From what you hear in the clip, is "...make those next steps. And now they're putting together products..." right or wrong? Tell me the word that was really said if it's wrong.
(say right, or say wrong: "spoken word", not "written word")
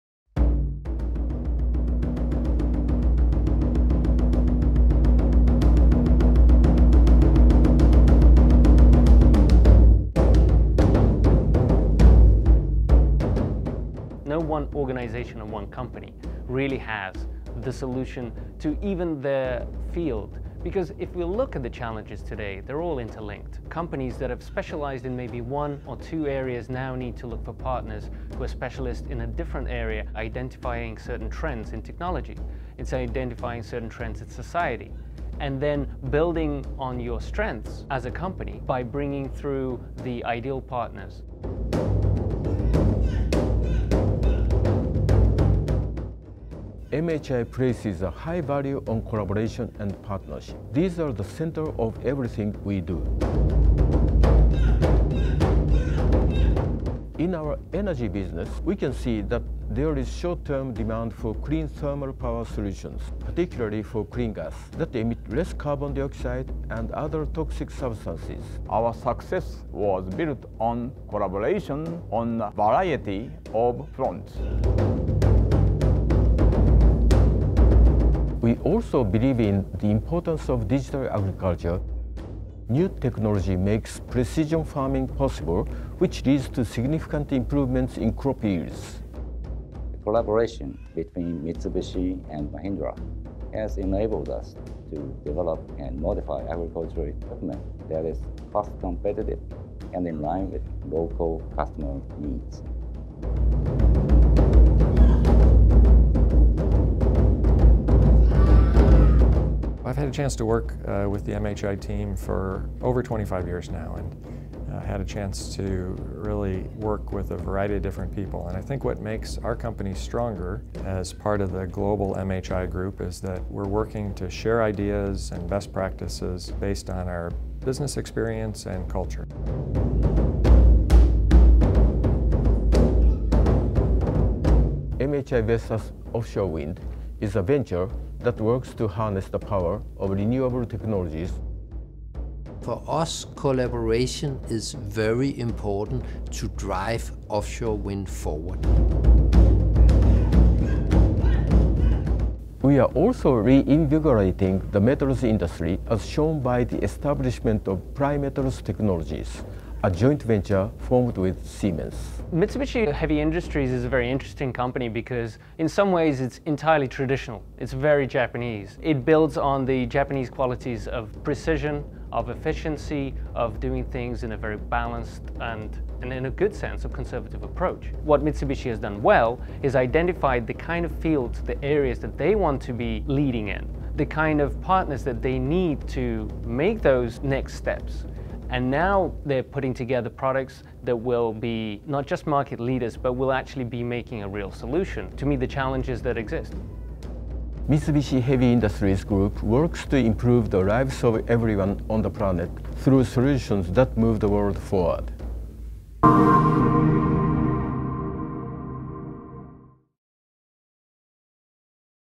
right.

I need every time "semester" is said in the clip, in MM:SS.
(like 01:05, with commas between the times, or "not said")
not said.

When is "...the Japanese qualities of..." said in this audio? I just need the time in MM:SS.
02:49.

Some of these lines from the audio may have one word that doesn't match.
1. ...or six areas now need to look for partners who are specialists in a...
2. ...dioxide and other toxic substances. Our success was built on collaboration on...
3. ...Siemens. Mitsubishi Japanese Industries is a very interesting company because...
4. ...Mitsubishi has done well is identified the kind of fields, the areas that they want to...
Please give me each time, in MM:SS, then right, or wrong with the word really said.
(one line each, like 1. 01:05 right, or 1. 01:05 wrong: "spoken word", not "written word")
1. 00:25 wrong: "two", not "six"
2. 01:05 right
3. 02:41 wrong: "Heavy", not "Japanese"
4. 02:58 right.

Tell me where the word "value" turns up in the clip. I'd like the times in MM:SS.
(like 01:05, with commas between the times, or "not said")
00:48.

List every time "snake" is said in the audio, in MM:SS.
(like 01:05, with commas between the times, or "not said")
not said.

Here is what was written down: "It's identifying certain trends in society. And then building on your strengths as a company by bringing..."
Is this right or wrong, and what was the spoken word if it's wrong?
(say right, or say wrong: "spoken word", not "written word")
right.